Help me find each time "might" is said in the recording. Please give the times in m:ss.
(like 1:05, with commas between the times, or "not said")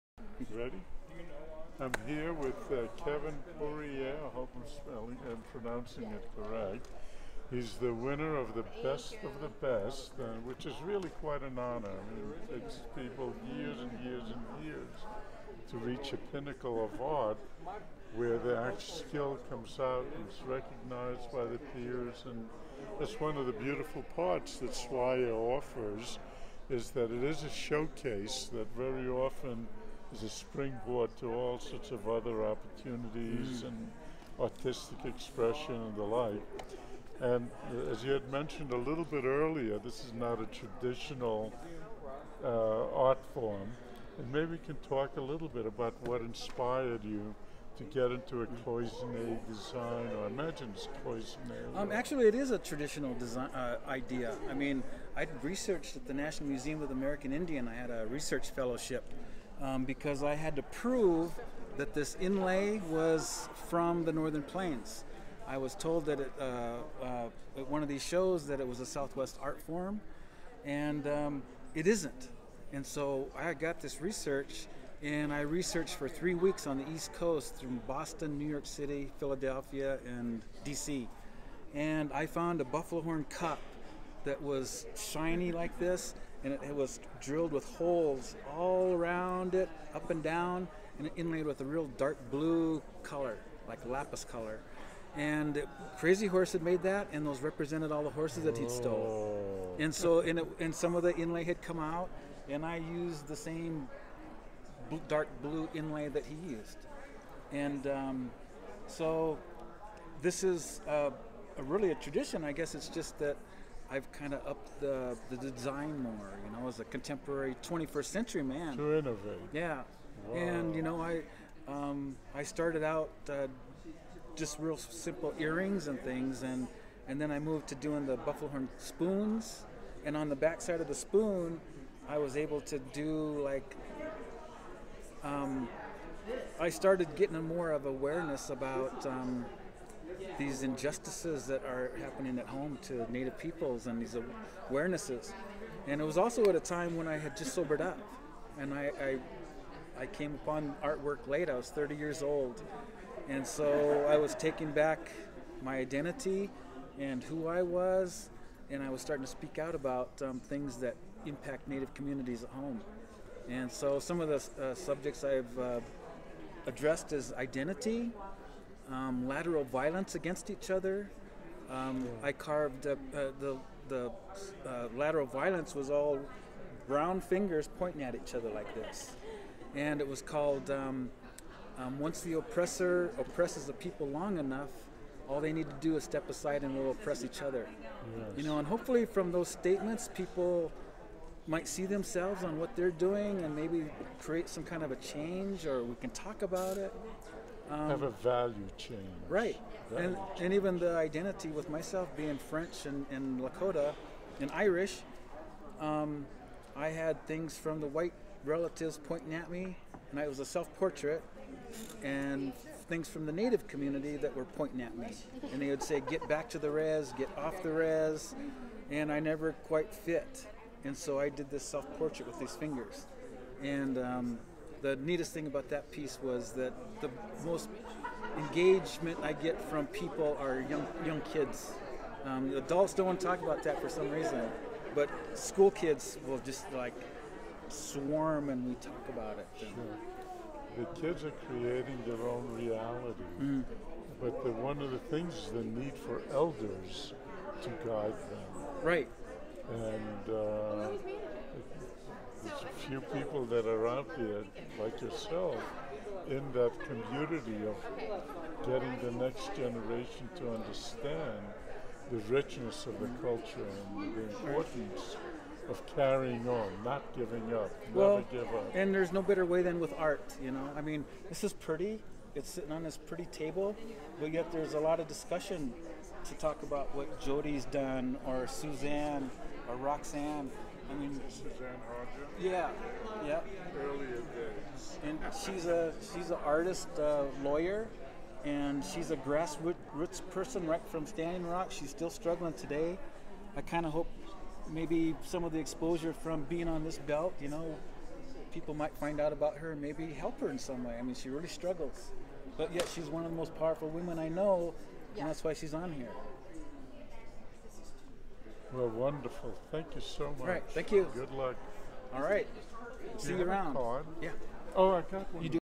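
3:11, 4:58.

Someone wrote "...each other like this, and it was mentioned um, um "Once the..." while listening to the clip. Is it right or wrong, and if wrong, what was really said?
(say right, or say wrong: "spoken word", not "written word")
wrong: "called", not "mentioned".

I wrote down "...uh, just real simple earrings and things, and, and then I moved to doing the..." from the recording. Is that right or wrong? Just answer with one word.
right.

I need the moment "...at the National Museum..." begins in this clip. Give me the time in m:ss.
0:55.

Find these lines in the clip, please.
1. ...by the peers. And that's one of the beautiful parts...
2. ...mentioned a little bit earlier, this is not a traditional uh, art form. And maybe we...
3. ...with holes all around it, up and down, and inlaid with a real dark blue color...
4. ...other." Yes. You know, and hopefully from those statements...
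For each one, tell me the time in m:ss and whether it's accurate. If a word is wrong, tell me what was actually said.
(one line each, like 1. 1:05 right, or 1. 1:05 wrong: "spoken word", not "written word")
1. 0:21 right
2. 0:38 right
3. 1:27 right
4. 3:07 right.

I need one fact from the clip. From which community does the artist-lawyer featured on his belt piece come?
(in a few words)
Standing Rock.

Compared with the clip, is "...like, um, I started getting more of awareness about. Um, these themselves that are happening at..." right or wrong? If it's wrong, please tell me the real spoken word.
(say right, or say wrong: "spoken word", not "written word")
wrong: "injustices", not "themselves".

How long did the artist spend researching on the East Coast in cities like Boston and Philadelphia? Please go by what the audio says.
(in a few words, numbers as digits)
3 weeks.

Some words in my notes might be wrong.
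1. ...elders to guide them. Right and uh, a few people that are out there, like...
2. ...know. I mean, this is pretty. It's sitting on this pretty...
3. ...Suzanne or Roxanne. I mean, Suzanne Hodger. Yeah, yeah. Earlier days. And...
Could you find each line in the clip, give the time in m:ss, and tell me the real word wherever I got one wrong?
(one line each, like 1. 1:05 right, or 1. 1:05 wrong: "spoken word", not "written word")
1. 4:06 right
2. 4:30 right
3. 4:38 right.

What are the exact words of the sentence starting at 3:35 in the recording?
And they would say, Get back to the res, get off the res, and I never quite fit.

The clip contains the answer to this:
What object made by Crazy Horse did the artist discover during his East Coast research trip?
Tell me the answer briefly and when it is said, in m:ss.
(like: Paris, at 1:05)
Buffalo horn cup, at 1:22.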